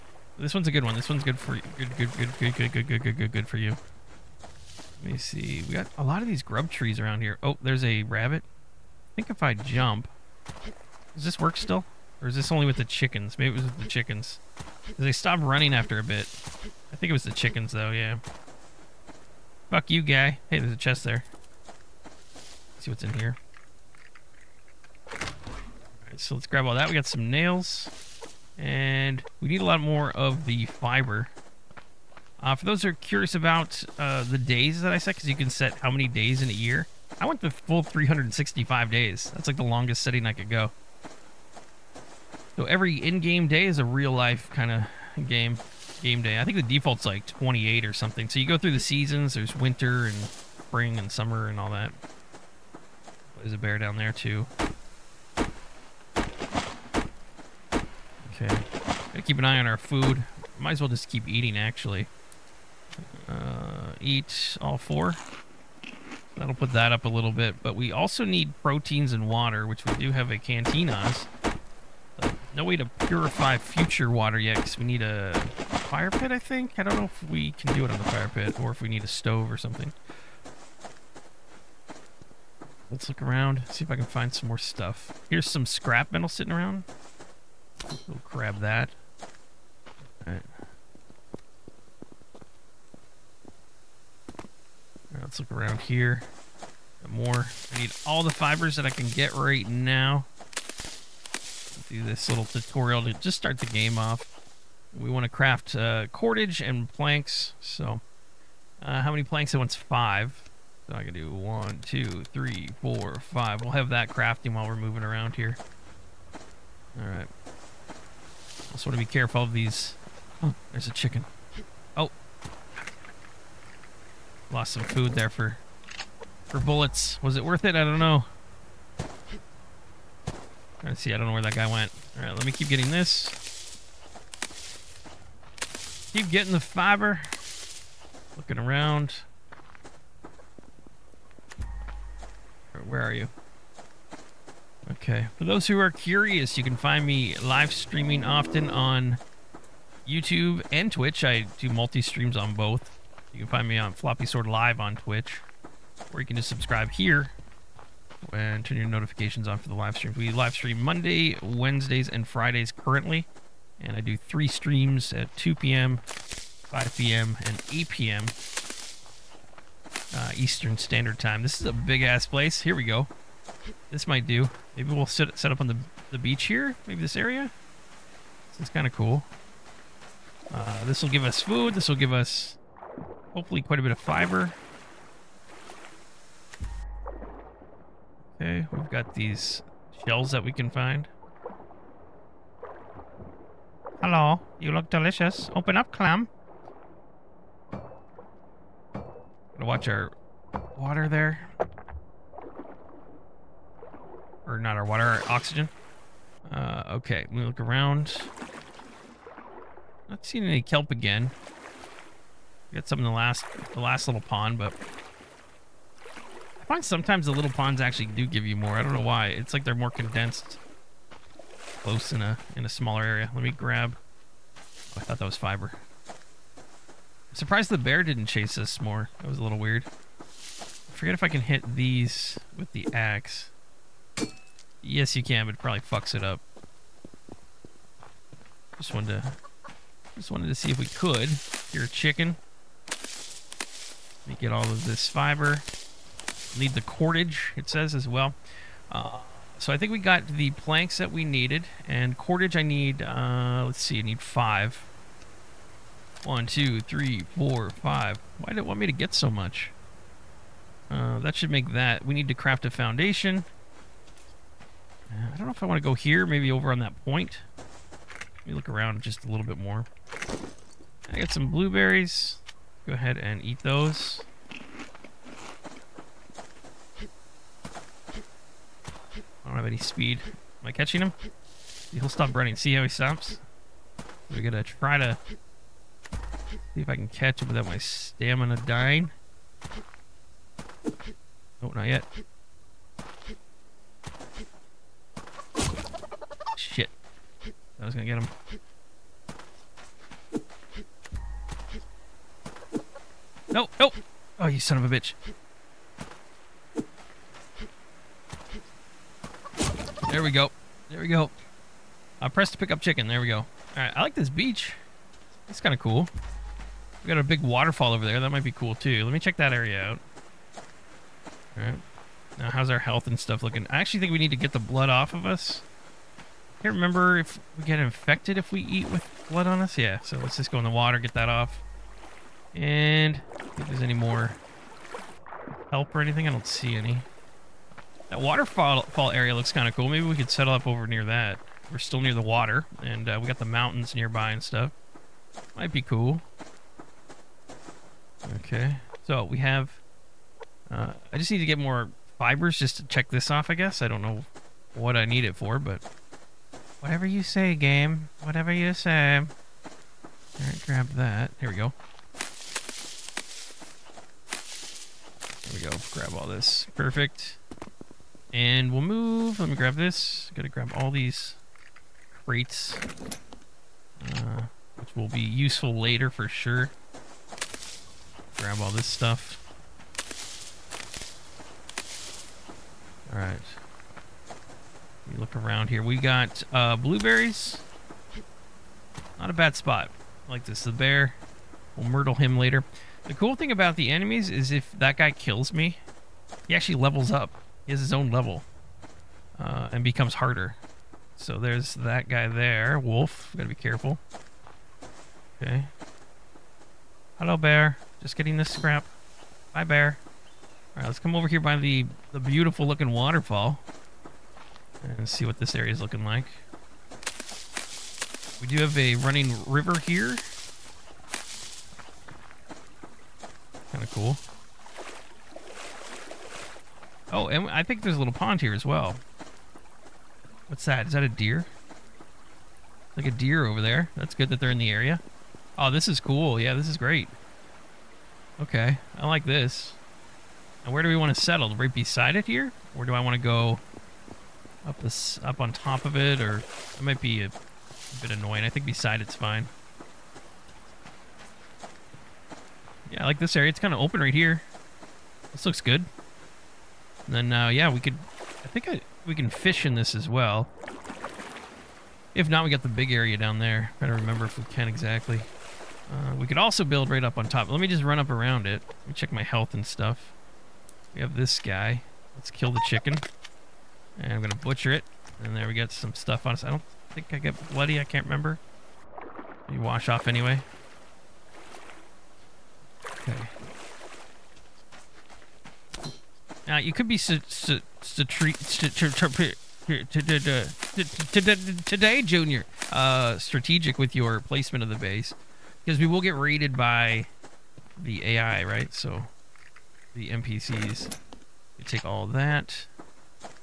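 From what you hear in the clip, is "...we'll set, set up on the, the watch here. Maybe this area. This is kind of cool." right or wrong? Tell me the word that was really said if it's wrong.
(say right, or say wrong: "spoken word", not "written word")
wrong: "beach", not "watch".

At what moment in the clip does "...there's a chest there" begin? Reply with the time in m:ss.
0:20.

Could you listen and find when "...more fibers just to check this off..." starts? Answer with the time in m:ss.
5:51.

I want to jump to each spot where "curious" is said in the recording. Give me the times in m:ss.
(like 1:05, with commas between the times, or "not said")
0:32, 2:25.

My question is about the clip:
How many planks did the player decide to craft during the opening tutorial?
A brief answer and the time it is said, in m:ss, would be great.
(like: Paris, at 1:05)
5, at 1:49.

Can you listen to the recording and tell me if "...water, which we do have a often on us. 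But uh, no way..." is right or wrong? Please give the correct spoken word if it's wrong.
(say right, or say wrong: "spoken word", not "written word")
wrong: "canteen", not "often".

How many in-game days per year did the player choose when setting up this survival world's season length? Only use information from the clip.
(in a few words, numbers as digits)
365.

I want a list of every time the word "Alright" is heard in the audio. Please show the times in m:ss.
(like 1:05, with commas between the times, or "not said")
0:25, 5:13, 5:21, 5:59, 6:23, 6:50.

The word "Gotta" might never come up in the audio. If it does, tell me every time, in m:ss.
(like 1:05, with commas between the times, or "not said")
0:58, 3:18, 6:10, 6:43.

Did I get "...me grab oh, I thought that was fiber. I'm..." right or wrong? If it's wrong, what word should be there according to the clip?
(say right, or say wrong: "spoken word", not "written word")
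right.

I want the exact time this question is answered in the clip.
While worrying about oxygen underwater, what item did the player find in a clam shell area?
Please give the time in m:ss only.
3:30.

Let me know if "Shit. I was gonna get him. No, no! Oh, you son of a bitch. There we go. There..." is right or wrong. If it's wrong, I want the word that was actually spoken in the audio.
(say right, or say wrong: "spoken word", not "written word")
right.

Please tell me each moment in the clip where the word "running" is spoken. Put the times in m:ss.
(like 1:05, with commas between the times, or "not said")
0:15, 4:42, 6:58.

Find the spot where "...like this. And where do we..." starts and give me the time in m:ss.
7:19.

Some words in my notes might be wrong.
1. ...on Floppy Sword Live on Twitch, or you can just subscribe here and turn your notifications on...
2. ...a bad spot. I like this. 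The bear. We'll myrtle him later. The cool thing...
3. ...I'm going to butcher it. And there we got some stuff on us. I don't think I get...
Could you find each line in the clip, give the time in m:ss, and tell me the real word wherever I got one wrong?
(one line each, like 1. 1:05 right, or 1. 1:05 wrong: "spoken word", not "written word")
1. 2:33 right
2. 6:29 right
3. 7:54 right.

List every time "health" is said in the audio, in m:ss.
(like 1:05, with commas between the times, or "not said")
5:22, 7:49.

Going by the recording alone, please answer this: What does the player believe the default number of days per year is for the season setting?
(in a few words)
28.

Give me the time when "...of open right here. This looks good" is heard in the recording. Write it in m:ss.
7:33.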